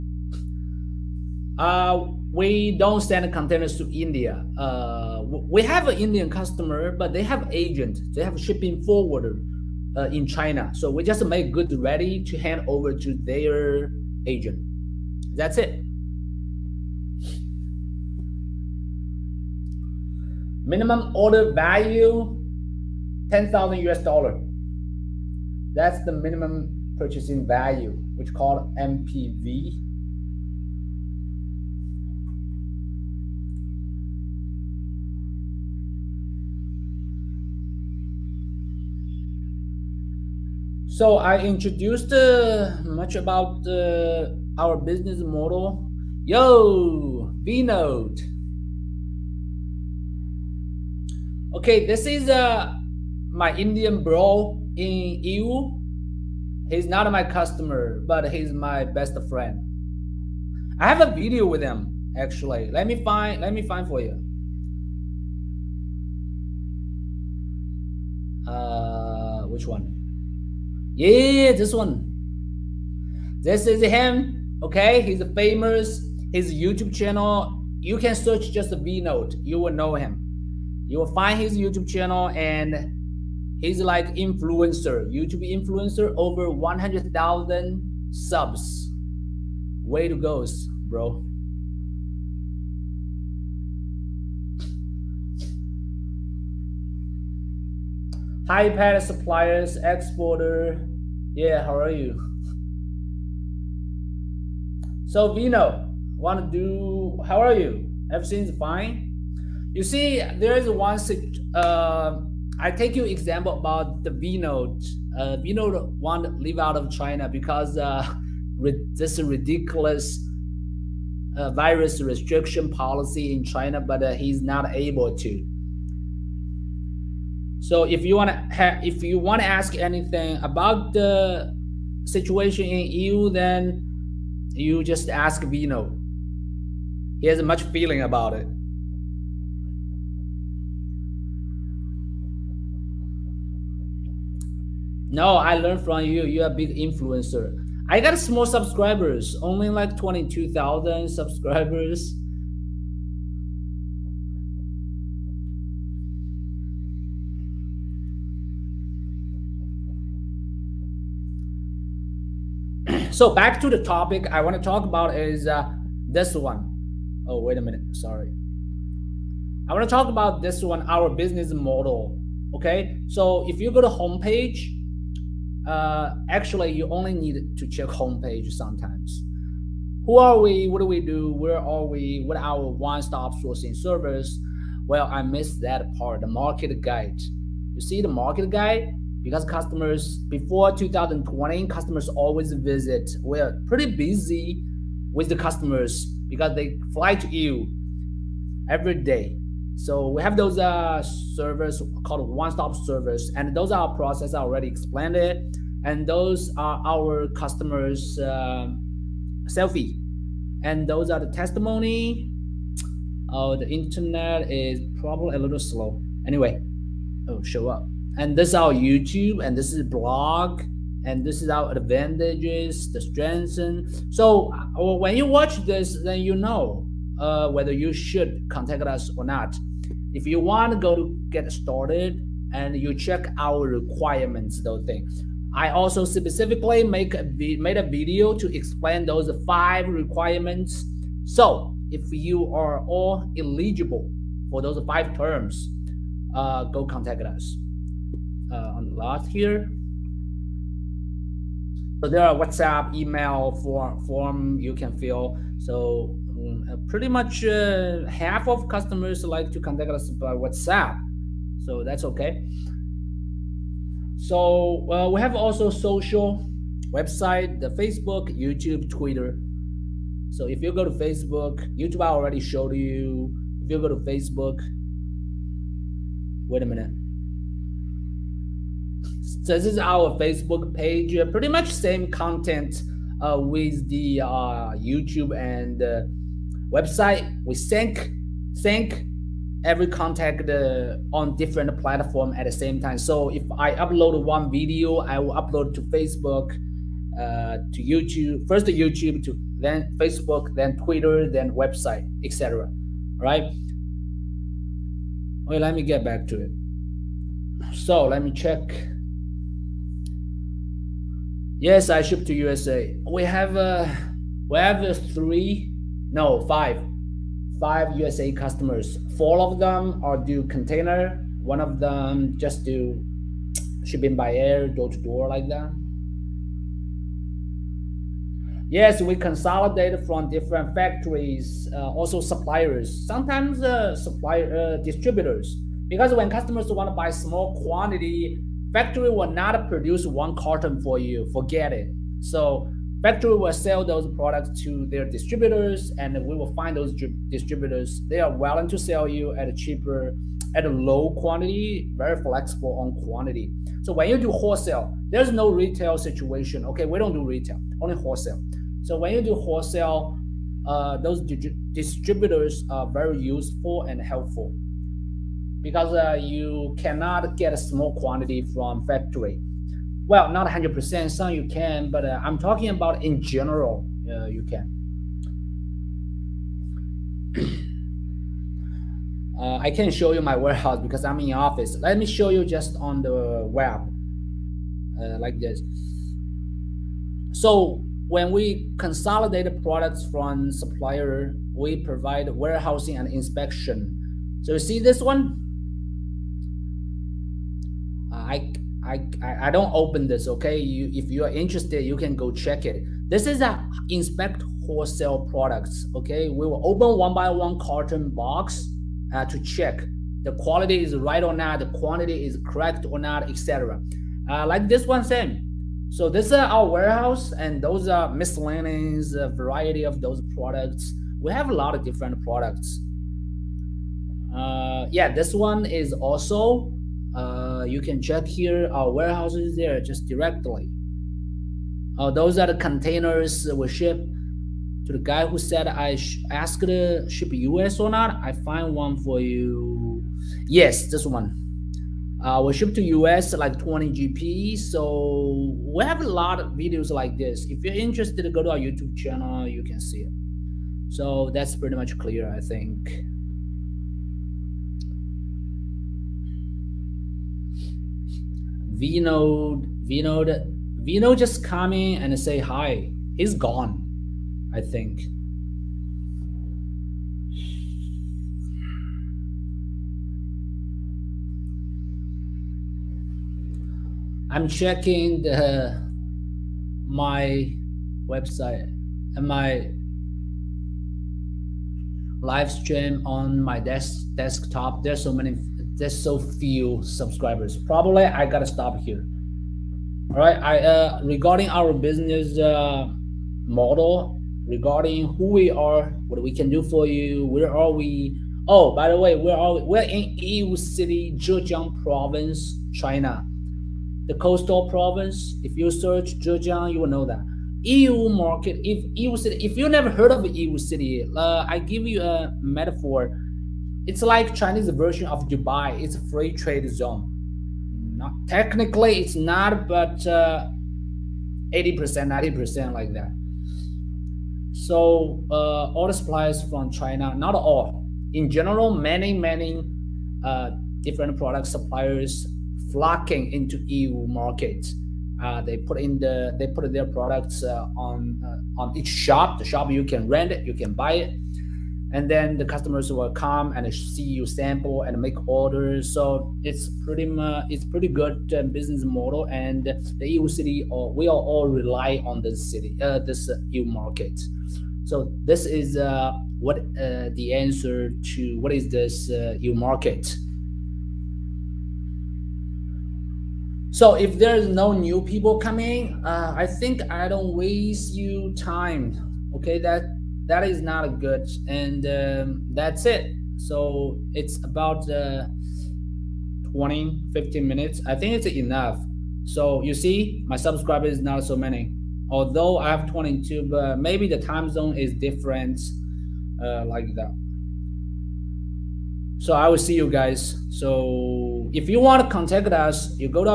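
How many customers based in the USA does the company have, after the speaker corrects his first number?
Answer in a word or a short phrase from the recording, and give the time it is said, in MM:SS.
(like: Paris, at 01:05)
5, at 05:17.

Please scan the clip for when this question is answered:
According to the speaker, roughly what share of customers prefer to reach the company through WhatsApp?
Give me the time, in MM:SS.
04:18.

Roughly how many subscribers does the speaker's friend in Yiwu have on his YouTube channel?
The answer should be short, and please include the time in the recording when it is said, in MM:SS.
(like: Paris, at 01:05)
over 100,000, at 01:26.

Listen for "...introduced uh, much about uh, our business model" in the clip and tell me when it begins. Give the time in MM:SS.
00:41.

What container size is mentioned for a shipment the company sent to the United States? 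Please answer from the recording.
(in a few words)
20 GP.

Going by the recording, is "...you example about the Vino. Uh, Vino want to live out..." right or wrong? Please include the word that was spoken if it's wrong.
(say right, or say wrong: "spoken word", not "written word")
right.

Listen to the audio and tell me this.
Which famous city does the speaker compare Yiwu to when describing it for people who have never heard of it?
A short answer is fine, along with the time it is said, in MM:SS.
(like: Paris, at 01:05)
Dubai, at 08:35.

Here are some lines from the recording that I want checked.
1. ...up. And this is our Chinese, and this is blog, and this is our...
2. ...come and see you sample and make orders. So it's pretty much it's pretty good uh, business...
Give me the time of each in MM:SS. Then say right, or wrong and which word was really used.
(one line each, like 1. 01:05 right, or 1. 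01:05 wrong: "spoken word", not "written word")
1. 03:37 wrong: "YouTube", not "Chinese"
2. 09:03 right.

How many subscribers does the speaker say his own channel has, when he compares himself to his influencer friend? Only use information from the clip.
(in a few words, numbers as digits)
22,000.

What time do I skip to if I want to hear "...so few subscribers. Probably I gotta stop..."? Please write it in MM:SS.
08:05.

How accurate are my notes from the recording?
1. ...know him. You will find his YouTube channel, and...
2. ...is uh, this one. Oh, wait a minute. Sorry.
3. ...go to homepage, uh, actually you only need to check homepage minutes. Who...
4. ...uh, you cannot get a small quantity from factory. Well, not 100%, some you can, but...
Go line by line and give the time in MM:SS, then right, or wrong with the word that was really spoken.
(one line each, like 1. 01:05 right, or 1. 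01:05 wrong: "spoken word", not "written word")
1. 01:19 right
2. 02:45 right
3. 02:53 wrong: "sometimes", not "minutes"
4. 06:05 right.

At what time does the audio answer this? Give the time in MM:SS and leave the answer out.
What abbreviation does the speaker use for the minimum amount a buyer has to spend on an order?
00:28.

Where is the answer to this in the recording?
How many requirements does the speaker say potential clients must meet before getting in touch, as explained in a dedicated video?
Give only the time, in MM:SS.
03:59.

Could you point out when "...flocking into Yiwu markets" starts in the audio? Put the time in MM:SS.
08:52.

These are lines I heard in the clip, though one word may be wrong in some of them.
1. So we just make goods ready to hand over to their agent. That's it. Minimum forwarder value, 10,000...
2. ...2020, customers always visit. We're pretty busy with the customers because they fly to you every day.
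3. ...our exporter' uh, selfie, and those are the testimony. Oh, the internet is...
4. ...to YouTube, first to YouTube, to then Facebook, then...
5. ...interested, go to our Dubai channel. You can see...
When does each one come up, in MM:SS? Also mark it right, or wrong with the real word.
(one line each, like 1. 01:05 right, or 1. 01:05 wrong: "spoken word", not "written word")
1. 00:10 wrong: "order", not "forwarder"
2. 03:10 right
3. 03:26 wrong: "customers", not "exporter"
4. 04:57 right
5. 07:27 wrong: "YouTube", not "Dubai".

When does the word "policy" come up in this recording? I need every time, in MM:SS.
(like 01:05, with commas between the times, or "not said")
02:02.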